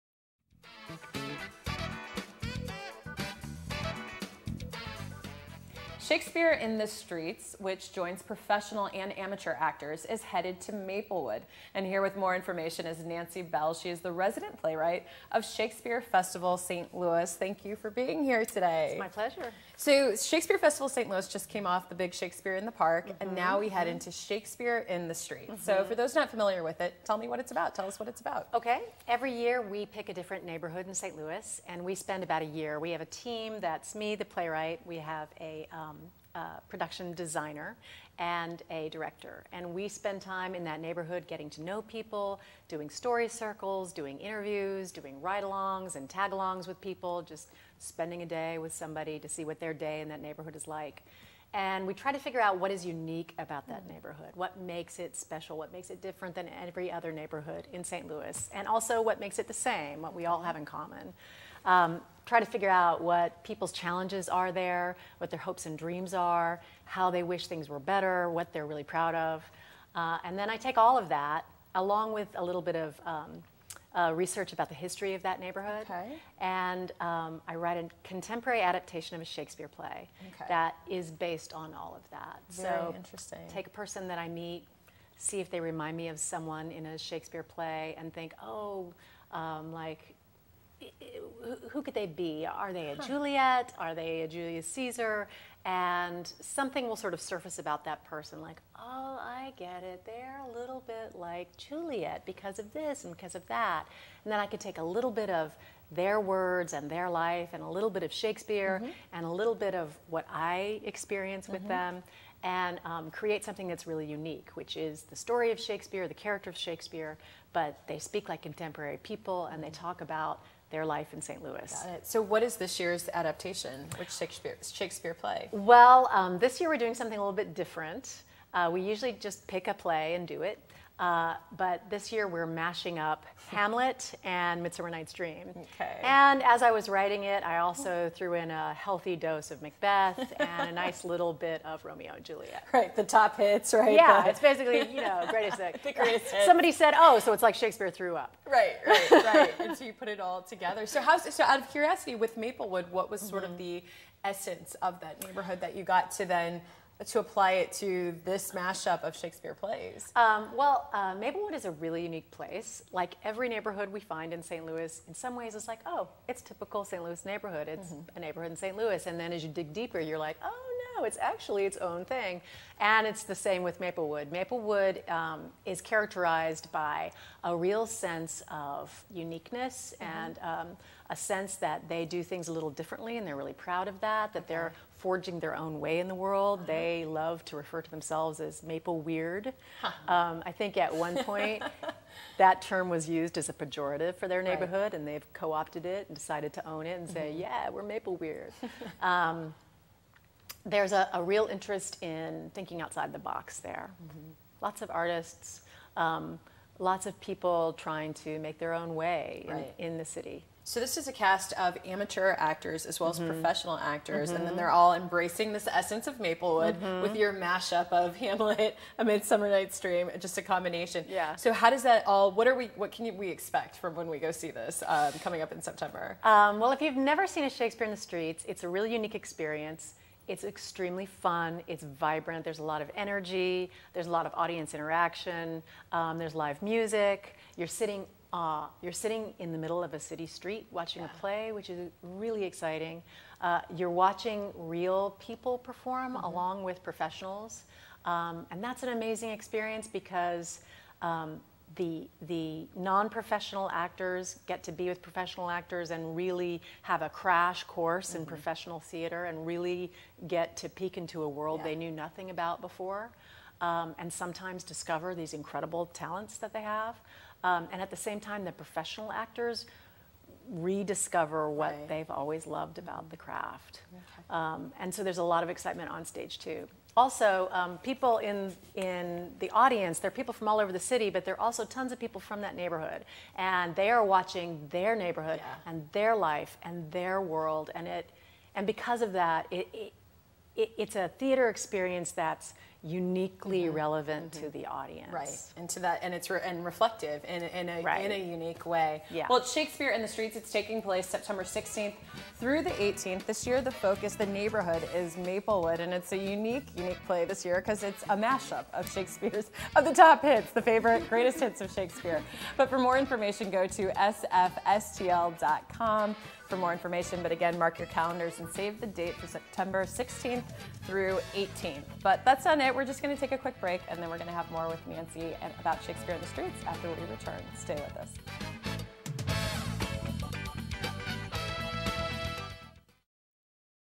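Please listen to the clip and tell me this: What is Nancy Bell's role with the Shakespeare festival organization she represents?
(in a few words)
Resident playwright.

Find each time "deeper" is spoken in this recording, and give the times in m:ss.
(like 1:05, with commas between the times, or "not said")
2:49.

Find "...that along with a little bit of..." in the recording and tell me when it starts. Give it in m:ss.
1:11.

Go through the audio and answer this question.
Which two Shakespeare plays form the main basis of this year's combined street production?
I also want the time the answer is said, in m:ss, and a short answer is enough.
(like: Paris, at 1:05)
Hamlet and Midsummer Night's Dream, at 2:13.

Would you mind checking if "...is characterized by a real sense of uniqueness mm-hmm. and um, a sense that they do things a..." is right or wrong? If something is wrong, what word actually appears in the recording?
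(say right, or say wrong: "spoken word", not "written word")
right.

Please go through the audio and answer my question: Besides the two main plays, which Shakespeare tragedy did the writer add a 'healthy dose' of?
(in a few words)
Macbeth.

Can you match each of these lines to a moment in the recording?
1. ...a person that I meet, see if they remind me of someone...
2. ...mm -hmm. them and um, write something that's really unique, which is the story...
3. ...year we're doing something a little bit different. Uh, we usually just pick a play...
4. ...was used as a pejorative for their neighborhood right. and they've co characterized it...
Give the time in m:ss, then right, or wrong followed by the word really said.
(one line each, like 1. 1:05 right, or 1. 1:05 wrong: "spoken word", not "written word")
1. 1:23 right
2. 1:51 wrong: "create", not "write"
3. 2:06 right
4. 3:12 wrong: "opted", not "characterized".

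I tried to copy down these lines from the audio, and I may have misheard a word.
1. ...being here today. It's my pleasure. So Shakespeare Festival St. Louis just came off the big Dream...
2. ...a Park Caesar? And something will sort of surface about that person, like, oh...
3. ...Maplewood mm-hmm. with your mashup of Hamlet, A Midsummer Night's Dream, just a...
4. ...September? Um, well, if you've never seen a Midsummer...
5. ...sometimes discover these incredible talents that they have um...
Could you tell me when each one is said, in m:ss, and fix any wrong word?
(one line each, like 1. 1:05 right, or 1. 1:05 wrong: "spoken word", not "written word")
1. 0:17 wrong: "Shakespeare", not "Dream"
2. 1:34 wrong: "Julius", not "Park"
3. 3:36 right
4. 3:45 wrong: "Shakespeare", not "Midsummer"
5. 4:24 right.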